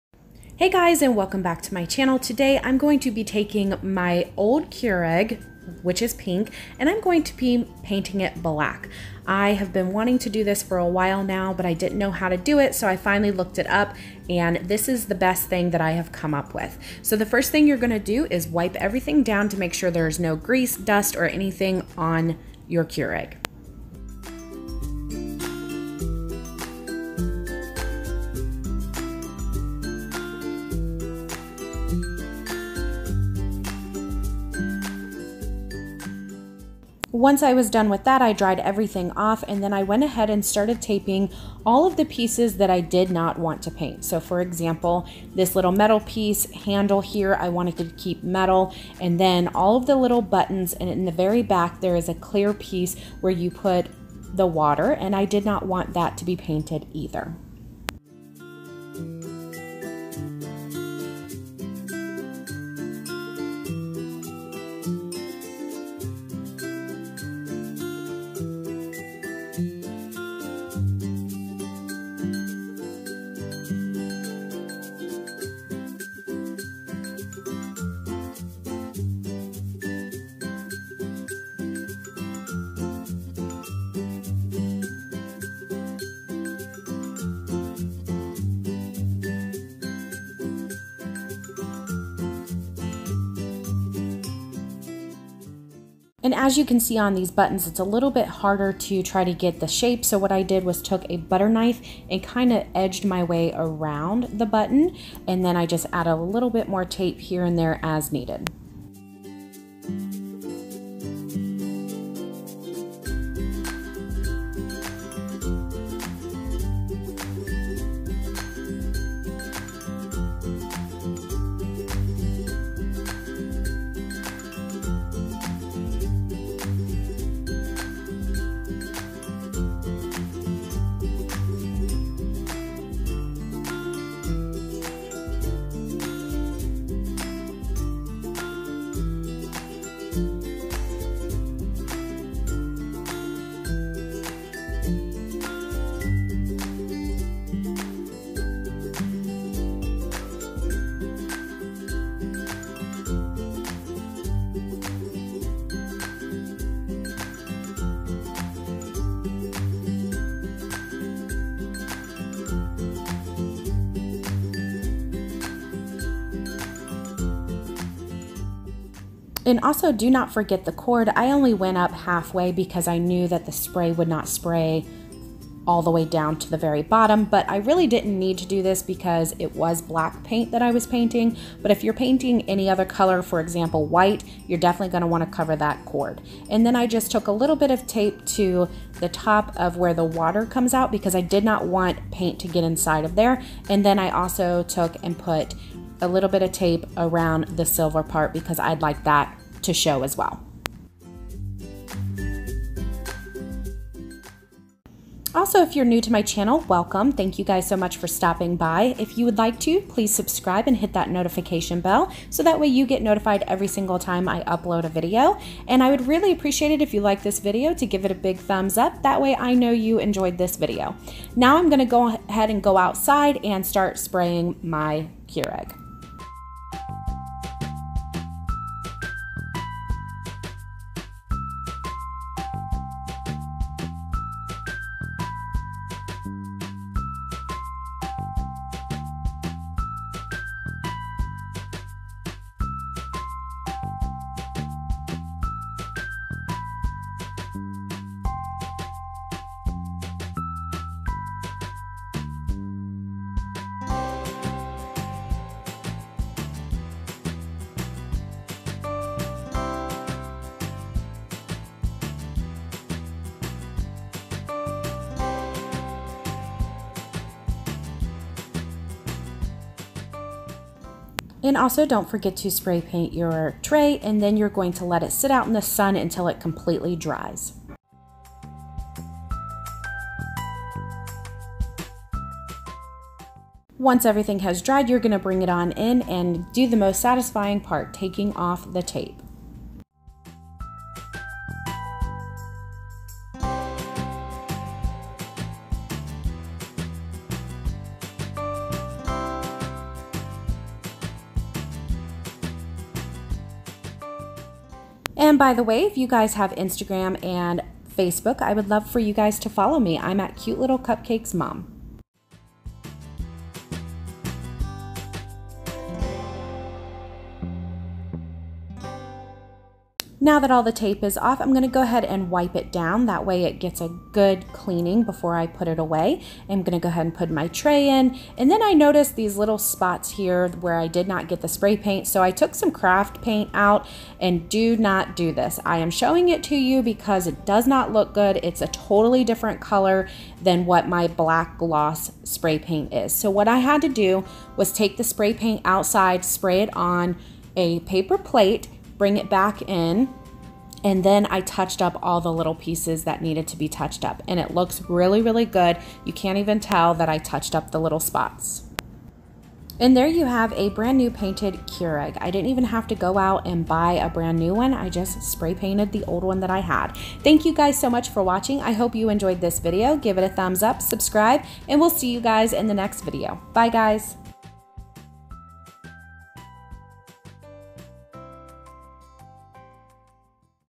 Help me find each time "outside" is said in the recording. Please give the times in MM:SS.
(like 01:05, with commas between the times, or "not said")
03:42, 05:45.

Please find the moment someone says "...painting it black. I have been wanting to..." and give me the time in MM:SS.
00:07.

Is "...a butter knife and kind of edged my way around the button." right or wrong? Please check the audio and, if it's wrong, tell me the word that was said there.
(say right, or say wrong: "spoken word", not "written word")
right.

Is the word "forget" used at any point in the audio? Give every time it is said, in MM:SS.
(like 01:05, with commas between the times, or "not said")
02:50, 04:32.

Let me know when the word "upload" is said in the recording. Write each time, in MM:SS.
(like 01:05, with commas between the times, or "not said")
03:34.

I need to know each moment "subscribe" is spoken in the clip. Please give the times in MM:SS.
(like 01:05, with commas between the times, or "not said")
03:30, 06:10.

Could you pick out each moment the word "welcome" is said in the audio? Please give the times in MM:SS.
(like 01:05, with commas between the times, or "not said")
00:01, 03:26.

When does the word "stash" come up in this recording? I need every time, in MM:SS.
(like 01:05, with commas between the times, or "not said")
not said.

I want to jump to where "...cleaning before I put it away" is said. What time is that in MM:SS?
05:24.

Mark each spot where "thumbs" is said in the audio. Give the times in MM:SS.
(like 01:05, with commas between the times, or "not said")
03:38, 06:10.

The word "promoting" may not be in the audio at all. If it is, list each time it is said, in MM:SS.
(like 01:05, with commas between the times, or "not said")
not said.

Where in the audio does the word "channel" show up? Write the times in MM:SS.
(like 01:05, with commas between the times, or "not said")
00:01, 03:26.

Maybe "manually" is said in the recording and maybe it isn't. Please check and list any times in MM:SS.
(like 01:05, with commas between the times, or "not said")
not said.